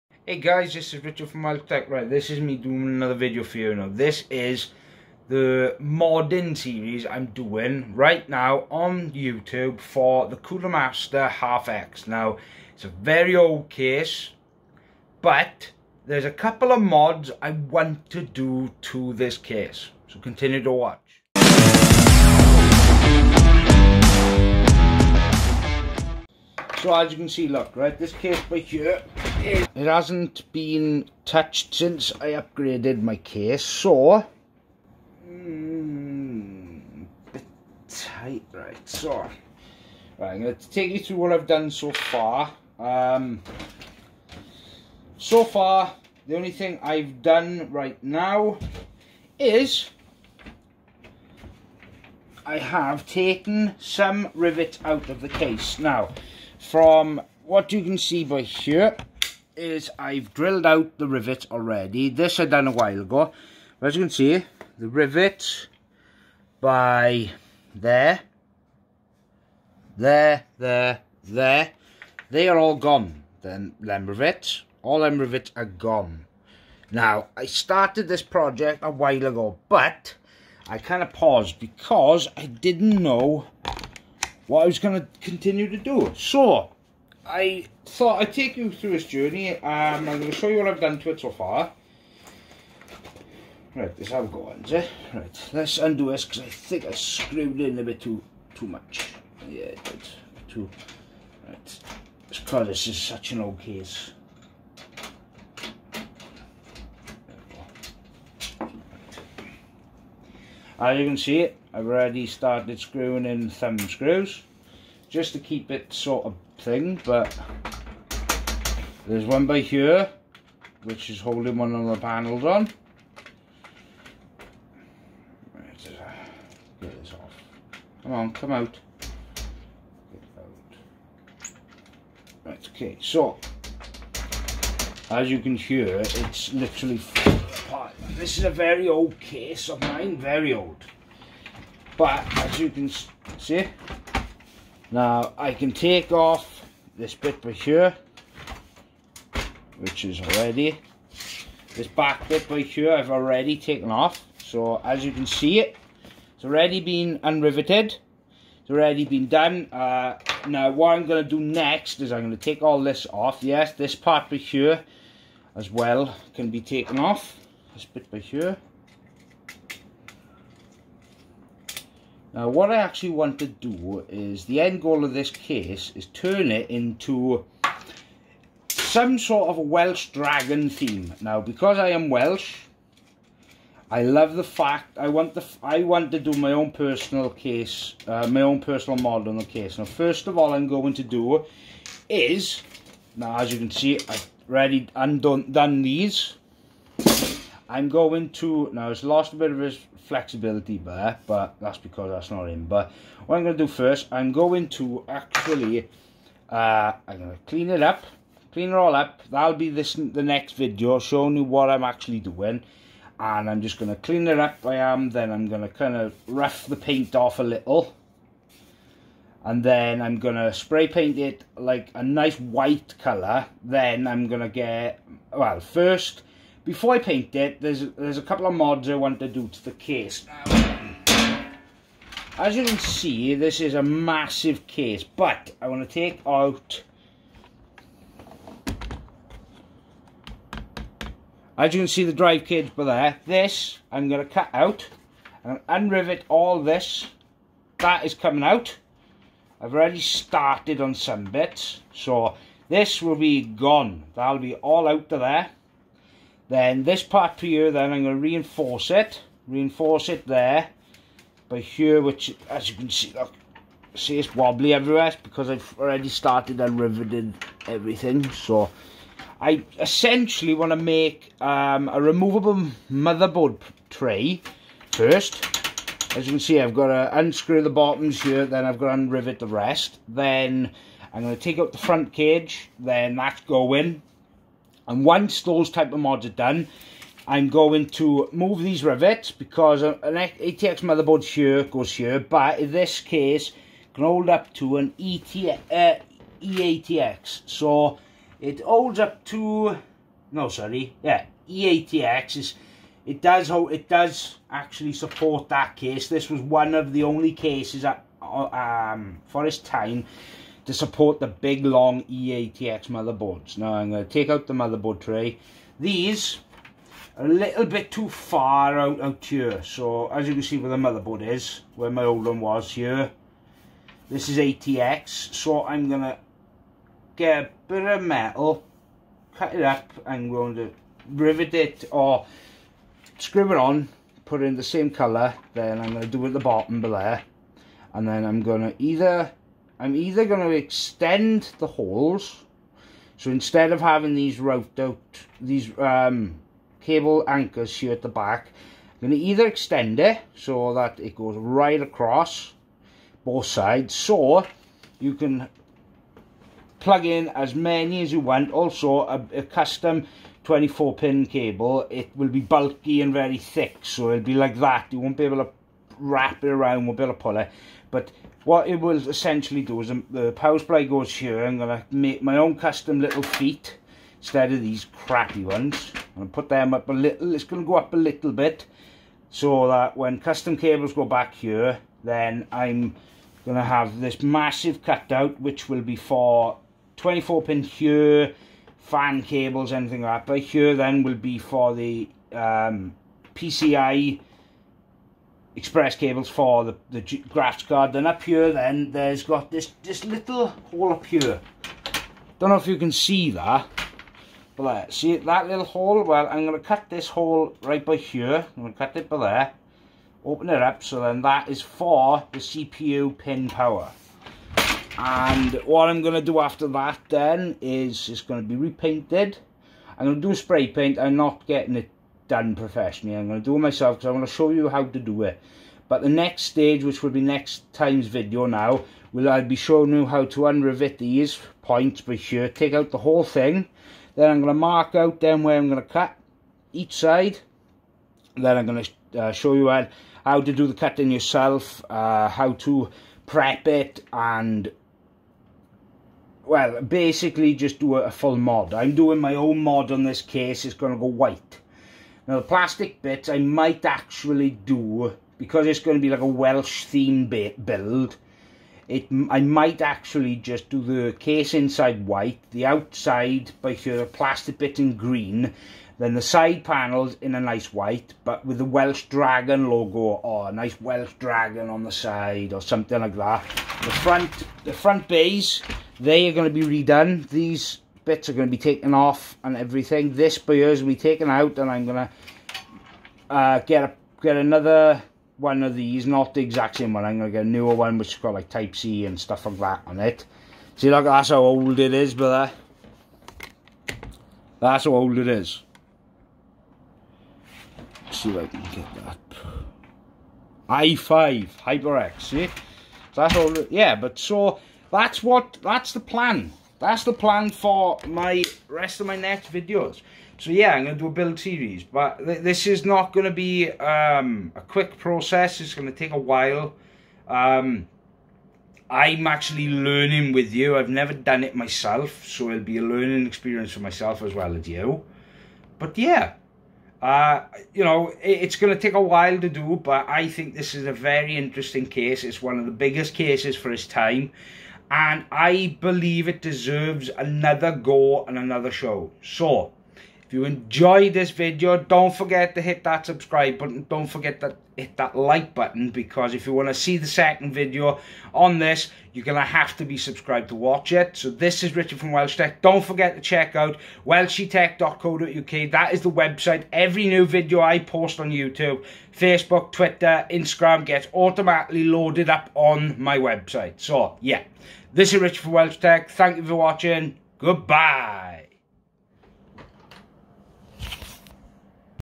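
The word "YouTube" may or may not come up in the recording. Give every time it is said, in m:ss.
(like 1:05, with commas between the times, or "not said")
0:09, 9:18.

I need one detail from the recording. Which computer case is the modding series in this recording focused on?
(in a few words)
Cooler Master HAF X.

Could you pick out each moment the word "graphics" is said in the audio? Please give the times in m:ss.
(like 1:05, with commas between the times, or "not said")
6:37.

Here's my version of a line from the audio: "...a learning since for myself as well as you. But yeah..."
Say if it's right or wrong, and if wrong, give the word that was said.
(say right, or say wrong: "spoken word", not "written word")
wrong: "experience", not "since".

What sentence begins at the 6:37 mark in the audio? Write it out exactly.
Then up here, then there's got this, this little hole up here.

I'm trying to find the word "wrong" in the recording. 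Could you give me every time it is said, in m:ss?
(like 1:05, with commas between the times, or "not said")
not said.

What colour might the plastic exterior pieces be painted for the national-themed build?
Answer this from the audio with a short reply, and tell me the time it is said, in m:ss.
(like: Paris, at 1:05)
Green, at 7:44.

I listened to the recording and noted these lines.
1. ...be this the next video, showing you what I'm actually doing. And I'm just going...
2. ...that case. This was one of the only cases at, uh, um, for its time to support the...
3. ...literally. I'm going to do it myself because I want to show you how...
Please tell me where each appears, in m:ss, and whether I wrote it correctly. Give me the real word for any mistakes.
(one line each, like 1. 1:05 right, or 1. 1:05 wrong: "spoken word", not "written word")
1. 3:29 right
2. 5:05 right
3. 7:02 wrong: "professionally", not "literally".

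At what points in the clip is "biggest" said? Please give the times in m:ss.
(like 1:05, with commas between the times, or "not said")
8:52.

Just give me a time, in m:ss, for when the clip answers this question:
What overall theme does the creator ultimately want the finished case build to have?
2:59.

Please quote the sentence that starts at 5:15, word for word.
These a little bit too far out, out here.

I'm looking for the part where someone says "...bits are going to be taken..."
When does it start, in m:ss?
7:58.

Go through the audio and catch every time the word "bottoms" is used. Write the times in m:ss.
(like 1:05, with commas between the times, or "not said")
4:37, 5:36.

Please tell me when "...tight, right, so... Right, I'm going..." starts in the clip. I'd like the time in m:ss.
0:37.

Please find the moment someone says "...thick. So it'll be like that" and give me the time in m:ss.
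6:03.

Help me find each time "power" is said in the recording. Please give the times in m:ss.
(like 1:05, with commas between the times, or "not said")
6:10, 6:53.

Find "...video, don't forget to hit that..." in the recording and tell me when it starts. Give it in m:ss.
9:01.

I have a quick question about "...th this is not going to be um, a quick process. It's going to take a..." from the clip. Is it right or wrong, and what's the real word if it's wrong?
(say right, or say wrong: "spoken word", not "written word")
right.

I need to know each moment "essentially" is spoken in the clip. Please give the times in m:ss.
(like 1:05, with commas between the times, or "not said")
4:29, 6:09.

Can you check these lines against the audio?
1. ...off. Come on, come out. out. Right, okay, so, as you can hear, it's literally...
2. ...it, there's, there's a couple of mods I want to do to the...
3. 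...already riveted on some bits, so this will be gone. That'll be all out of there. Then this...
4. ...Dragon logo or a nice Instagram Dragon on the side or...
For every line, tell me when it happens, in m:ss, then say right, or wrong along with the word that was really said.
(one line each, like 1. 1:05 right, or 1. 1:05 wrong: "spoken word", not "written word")
1. 2:07 right
2. 3:47 right
3. 4:09 wrong: "started", not "riveted"
4. 7:49 wrong: "Welsh", not "Instagram".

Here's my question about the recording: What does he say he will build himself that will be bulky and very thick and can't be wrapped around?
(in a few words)
Custom 24 pin cable.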